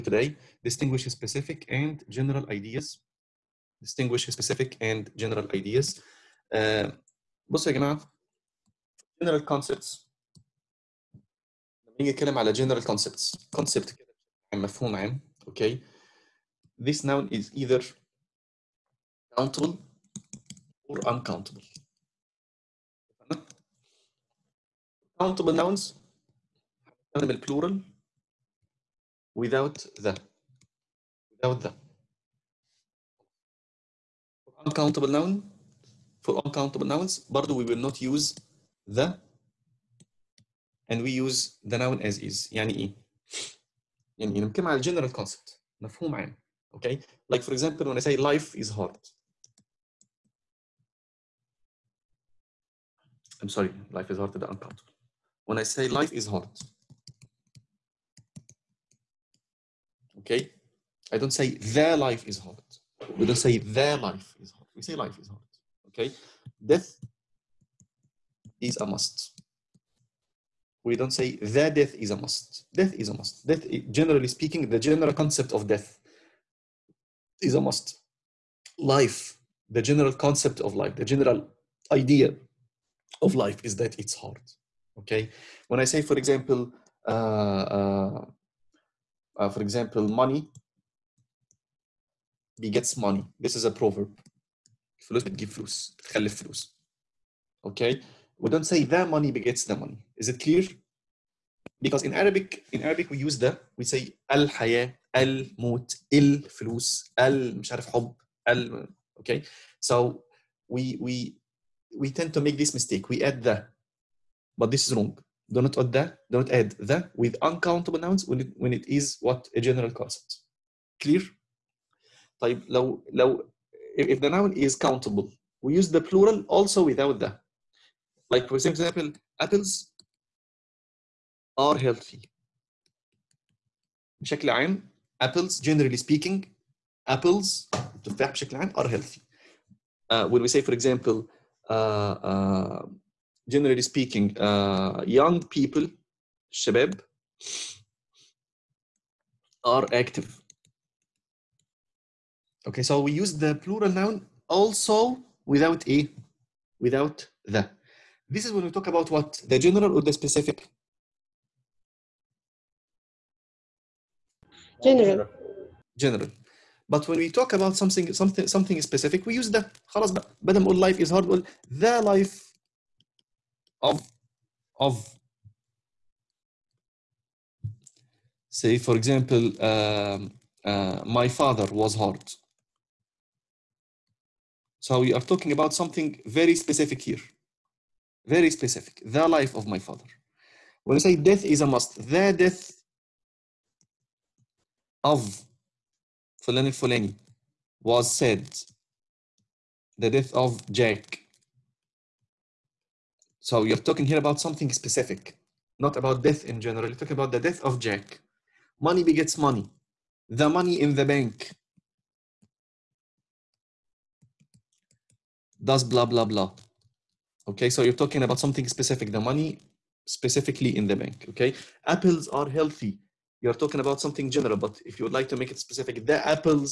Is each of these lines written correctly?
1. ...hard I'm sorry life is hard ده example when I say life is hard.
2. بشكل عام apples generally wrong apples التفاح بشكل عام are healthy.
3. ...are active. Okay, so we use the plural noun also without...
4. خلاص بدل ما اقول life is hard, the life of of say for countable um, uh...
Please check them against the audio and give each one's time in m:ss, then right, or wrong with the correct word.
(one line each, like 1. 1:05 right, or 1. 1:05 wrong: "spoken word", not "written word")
1. 0:48 wrong: "uncountable", not "example"
2. 2:14 wrong: "speaking", not "wrong"
3. 2:29 right
4. 2:49 wrong: "example", not "countable".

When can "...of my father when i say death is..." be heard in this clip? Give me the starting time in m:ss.
3:09.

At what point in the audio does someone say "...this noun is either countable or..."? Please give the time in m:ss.
0:16.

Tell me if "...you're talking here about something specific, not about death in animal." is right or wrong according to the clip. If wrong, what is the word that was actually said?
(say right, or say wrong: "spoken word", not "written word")
wrong: "general", not "animal".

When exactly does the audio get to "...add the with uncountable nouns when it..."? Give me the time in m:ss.
1:56.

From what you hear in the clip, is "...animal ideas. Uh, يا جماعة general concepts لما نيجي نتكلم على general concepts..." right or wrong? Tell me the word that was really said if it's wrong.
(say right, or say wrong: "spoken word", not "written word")
wrong: "general", not "animal".